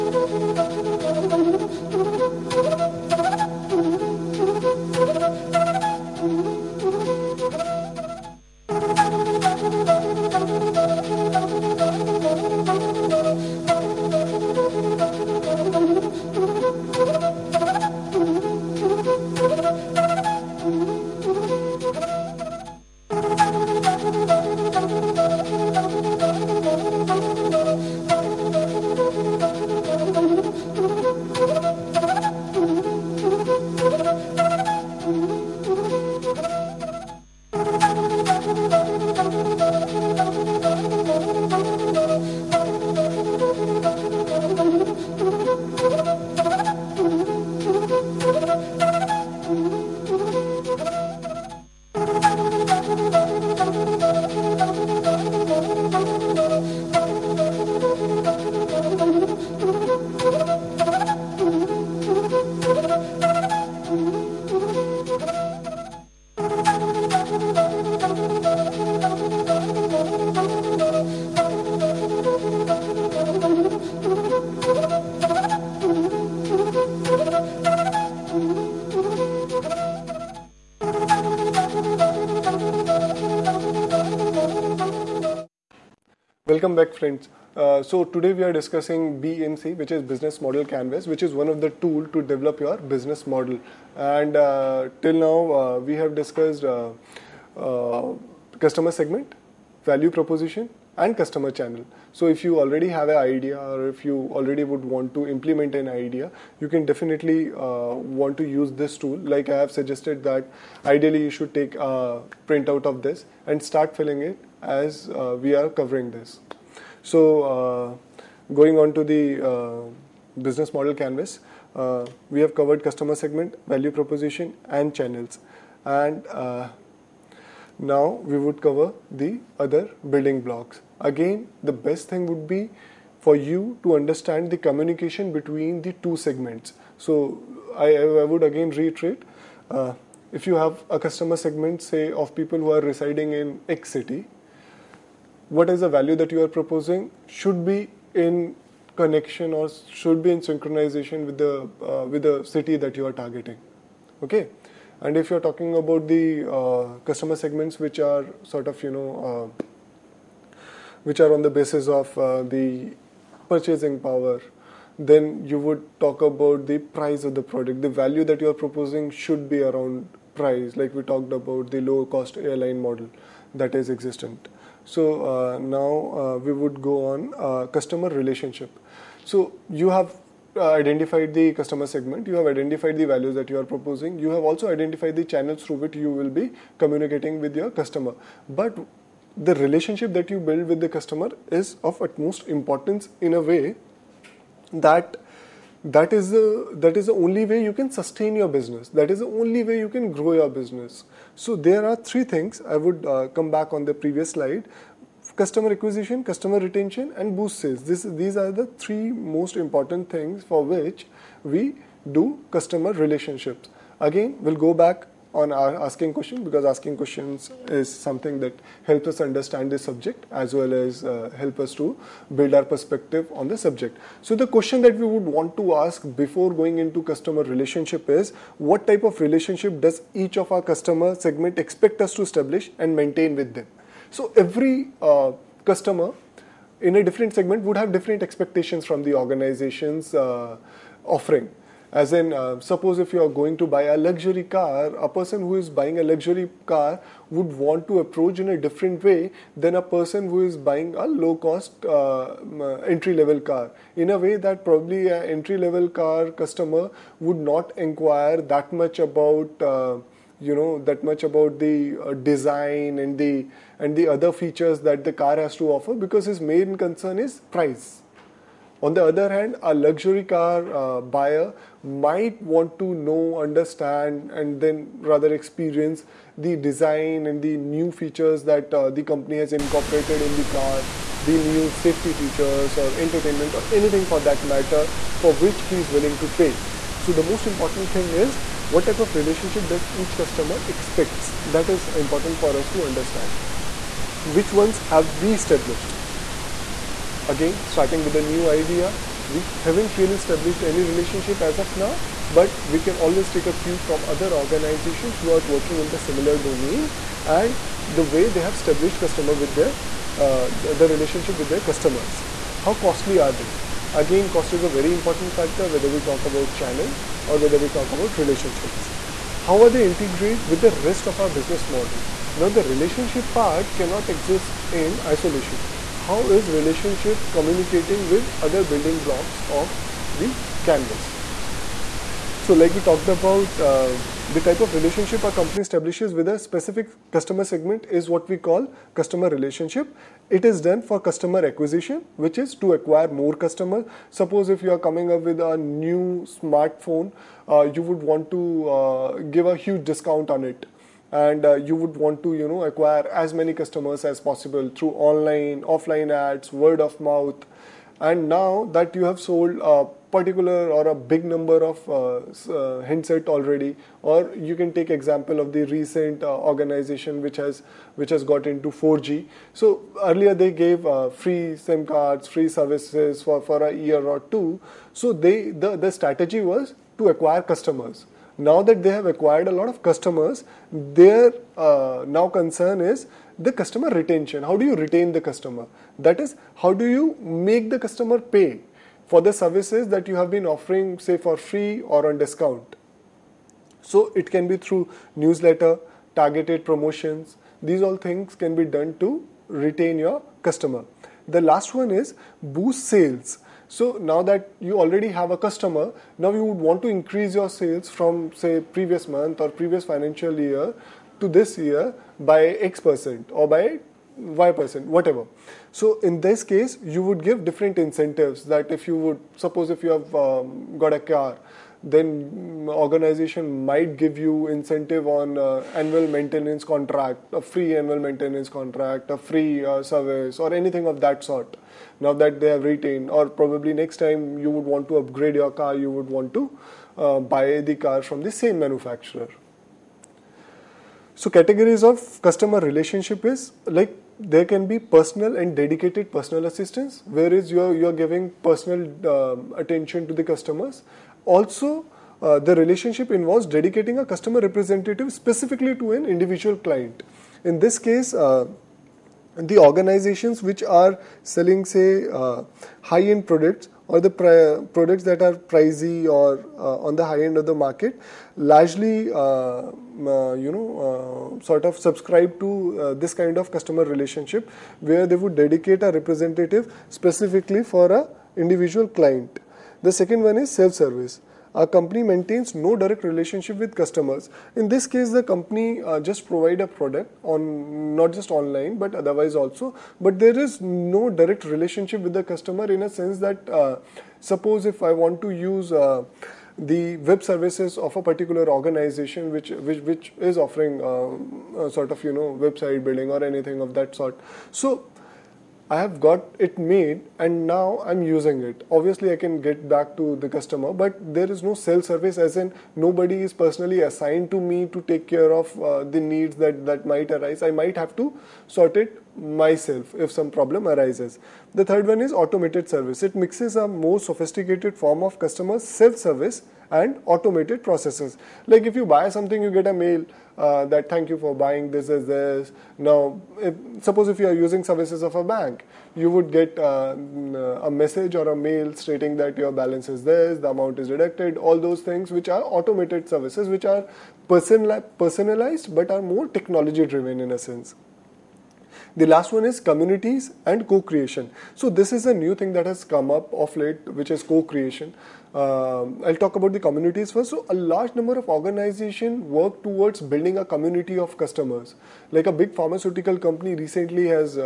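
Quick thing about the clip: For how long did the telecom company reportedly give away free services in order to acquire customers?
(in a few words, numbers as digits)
A year or two.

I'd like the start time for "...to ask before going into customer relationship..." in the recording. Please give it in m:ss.
3:45.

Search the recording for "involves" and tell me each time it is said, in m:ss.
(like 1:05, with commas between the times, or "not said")
7:33.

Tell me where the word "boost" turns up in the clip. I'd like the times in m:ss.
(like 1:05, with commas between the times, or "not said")
3:27, 6:42.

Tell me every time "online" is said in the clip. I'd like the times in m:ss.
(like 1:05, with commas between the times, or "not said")
5:54, 8:08.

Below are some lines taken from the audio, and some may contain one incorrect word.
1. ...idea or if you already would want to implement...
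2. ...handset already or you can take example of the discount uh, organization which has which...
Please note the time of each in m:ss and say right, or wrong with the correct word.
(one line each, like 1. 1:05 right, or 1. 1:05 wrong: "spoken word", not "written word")
1. 1:43 right
2. 6:02 wrong: "recent", not "discount".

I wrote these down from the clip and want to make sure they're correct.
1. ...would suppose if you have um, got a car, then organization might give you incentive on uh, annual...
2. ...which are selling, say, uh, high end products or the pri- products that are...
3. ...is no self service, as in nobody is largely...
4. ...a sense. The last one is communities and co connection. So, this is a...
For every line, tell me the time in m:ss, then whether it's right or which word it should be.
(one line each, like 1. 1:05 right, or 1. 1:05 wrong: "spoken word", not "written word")
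1. 6:58 right
2. 7:40 right
3. 8:31 wrong: "personally", not "largely"
4. 9:07 wrong: "creation", not "connection".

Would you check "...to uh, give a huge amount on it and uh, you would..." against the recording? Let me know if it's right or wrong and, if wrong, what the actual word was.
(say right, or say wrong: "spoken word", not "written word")
wrong: "discount", not "amount".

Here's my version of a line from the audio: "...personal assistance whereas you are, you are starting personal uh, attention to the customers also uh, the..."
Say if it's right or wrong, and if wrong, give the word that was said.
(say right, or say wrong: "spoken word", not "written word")
wrong: "giving", not "starting".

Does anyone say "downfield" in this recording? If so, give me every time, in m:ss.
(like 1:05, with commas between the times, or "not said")
not said.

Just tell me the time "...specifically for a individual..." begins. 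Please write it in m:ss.
7:56.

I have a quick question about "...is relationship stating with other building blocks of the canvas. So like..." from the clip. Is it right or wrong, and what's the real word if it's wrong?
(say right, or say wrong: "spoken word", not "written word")
wrong: "communicating", not "stating".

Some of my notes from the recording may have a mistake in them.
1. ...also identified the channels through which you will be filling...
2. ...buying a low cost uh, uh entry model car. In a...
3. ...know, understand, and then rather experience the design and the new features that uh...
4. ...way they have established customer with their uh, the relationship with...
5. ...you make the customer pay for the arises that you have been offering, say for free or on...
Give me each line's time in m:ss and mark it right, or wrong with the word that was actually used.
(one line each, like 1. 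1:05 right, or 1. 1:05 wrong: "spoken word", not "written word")
1. 3:04 wrong: "communicating", not "filling"
2. 4:10 wrong: "level", not "model"
3. 4:32 right
4. 5:08 right
5. 6:26 wrong: "services", not "arises".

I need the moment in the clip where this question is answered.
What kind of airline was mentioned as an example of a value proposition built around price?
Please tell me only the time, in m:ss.
2:51.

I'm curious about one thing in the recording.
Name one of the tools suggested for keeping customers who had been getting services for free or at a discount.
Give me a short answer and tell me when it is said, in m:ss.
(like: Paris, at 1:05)
Newsletter, at 6:35.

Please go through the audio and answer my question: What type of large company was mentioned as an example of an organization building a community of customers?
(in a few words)
Pharmaceutical company.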